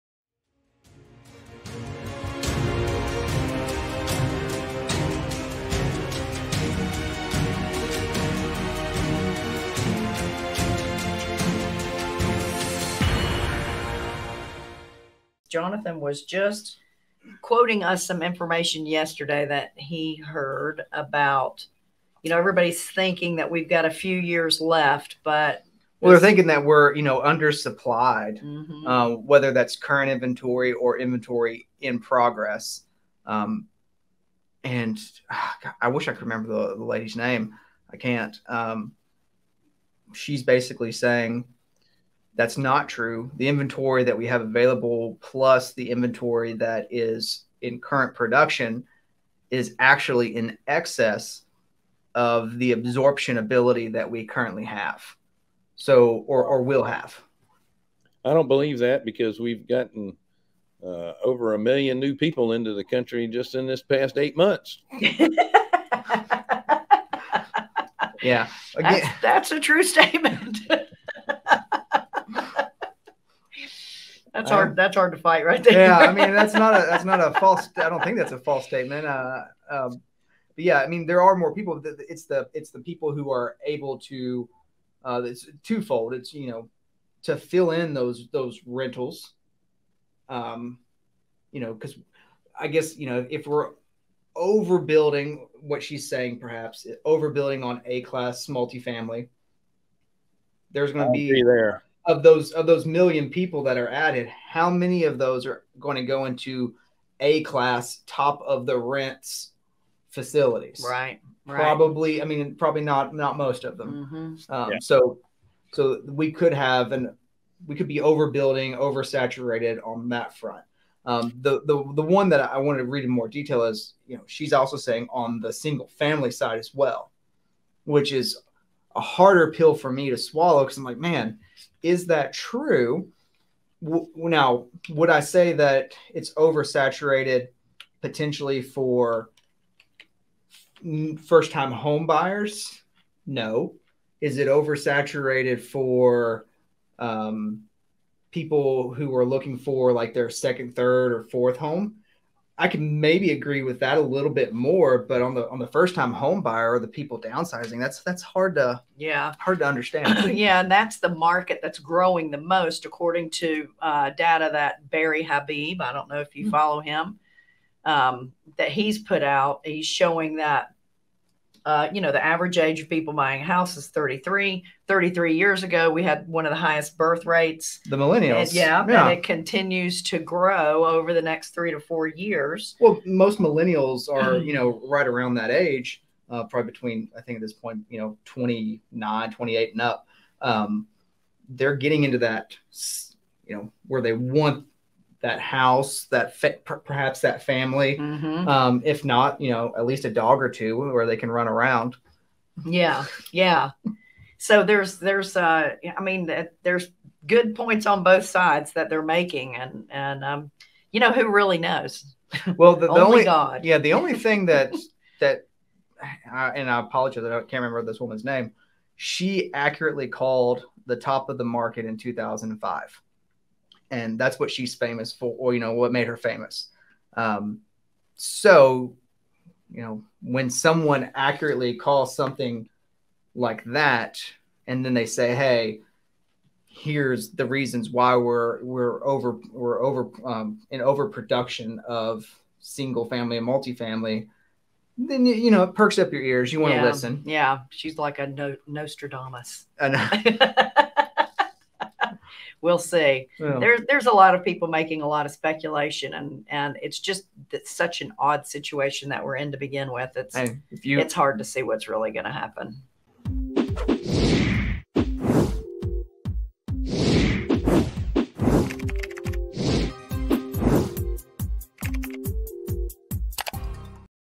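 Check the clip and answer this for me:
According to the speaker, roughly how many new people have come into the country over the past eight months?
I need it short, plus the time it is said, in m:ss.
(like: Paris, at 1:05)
over a million, at 1:01.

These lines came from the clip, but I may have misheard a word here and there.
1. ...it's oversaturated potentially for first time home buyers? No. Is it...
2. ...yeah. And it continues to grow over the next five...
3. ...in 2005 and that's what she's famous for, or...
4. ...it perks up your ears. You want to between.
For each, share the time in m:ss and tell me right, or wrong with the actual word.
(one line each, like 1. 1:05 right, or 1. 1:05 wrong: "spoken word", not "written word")
1. 2:16 right
2. 2:58 wrong: "three", not "five"
3. 3:41 right
4. 4:05 wrong: "listen", not "between".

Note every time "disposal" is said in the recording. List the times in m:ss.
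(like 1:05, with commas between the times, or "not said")
not said.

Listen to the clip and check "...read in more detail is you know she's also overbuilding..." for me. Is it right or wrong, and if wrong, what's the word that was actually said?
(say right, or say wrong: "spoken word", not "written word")
wrong: "saying", not "overbuilding".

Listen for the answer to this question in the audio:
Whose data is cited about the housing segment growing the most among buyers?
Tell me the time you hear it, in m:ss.
2:44.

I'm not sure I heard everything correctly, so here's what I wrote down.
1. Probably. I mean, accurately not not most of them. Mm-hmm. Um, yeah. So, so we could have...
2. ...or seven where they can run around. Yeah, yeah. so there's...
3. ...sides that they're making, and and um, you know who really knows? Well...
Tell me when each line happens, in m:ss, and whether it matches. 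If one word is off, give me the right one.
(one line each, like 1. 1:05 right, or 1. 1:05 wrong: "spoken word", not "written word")
1. 1:51 wrong: "probably", not "accurately"
2. 3:20 wrong: "two", not "seven"
3. 3:28 right.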